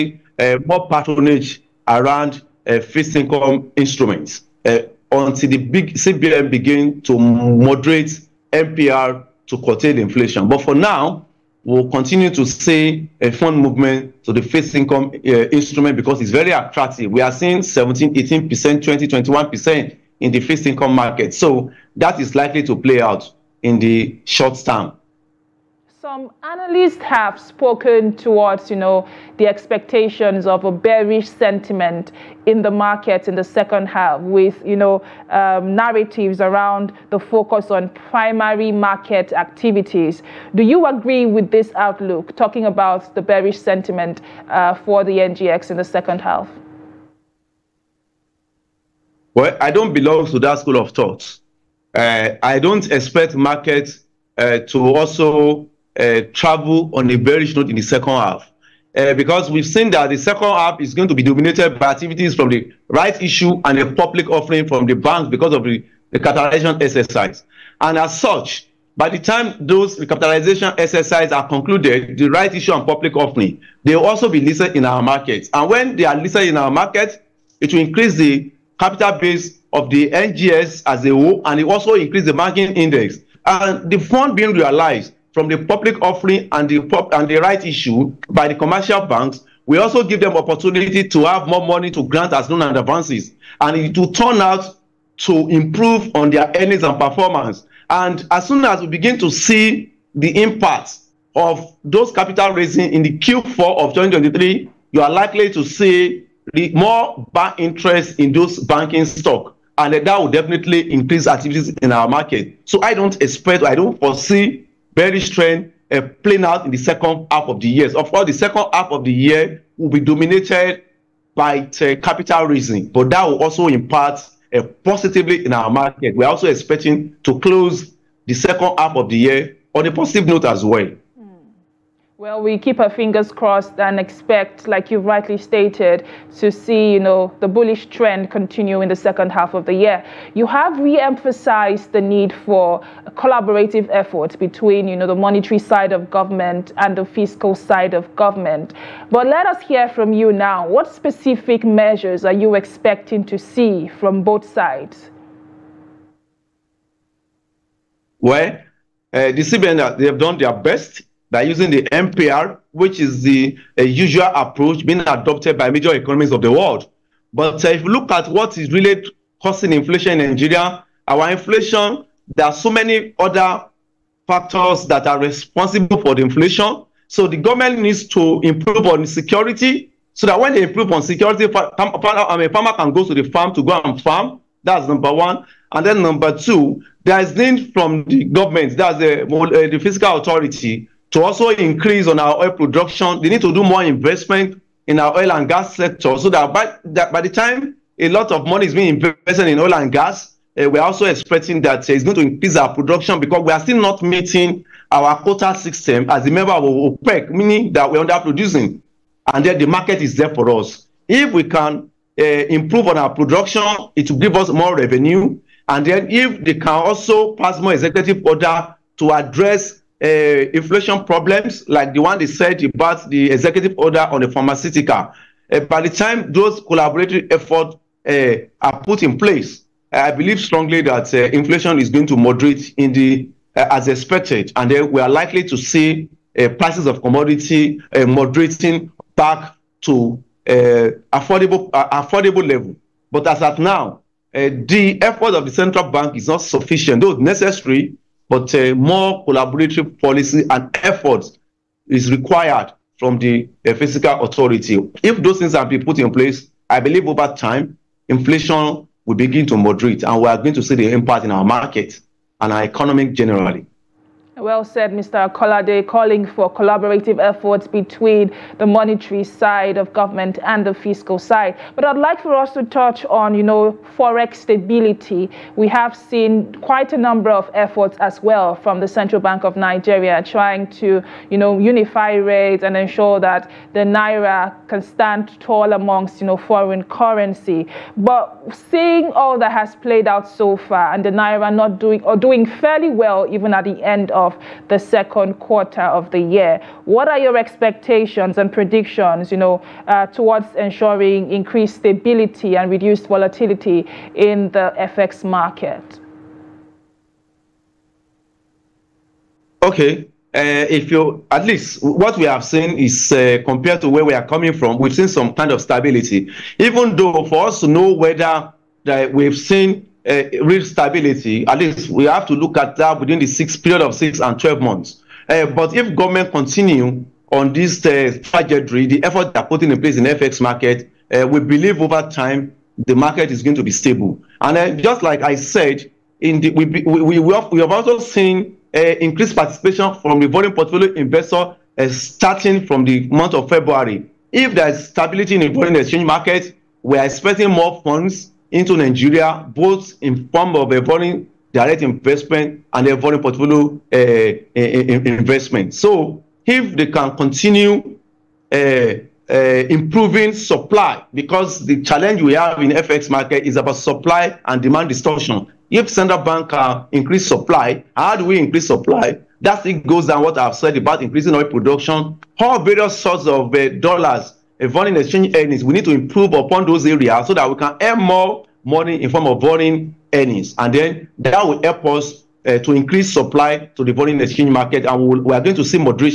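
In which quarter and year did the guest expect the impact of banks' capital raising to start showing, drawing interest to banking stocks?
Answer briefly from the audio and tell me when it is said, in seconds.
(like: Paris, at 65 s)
Q4 of 2023, at 103 s.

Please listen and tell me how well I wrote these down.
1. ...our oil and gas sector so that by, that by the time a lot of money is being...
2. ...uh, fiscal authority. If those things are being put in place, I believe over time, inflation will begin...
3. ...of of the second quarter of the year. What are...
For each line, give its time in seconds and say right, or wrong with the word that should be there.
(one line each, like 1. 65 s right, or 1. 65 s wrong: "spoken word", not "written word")
1. 194 s right
2. 253 s right
3. 294 s right.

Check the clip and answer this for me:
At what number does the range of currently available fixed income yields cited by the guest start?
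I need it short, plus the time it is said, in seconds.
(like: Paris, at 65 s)
17, at 17 s.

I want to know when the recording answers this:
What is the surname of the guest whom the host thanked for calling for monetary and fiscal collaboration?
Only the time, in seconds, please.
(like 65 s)
265 s.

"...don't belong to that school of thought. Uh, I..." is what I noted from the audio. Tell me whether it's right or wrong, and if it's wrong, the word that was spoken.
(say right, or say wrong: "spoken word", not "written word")
right.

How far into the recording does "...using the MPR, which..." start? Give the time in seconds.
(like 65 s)
161 s.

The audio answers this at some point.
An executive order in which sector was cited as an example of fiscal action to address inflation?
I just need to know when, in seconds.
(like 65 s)
224 s.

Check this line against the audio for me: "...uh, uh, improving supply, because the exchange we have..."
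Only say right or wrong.
wrong.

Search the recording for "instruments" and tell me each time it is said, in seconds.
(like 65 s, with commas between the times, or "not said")
3 s, 15 s.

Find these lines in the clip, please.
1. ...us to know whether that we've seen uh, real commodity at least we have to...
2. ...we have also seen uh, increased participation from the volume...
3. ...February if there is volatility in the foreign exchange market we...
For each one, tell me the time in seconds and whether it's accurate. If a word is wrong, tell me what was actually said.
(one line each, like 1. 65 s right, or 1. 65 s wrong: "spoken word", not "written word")
1. 317 s wrong: "stability", not "commodity"
2. 337 s right
3. 343 s wrong: "stability", not "volatility".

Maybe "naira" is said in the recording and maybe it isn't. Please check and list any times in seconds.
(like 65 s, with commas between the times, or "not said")
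283 s, 291 s.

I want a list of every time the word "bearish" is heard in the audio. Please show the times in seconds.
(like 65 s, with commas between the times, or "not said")
30 s, 43 s, 57 s.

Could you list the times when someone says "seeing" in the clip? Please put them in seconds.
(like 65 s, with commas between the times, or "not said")
17 s, 288 s.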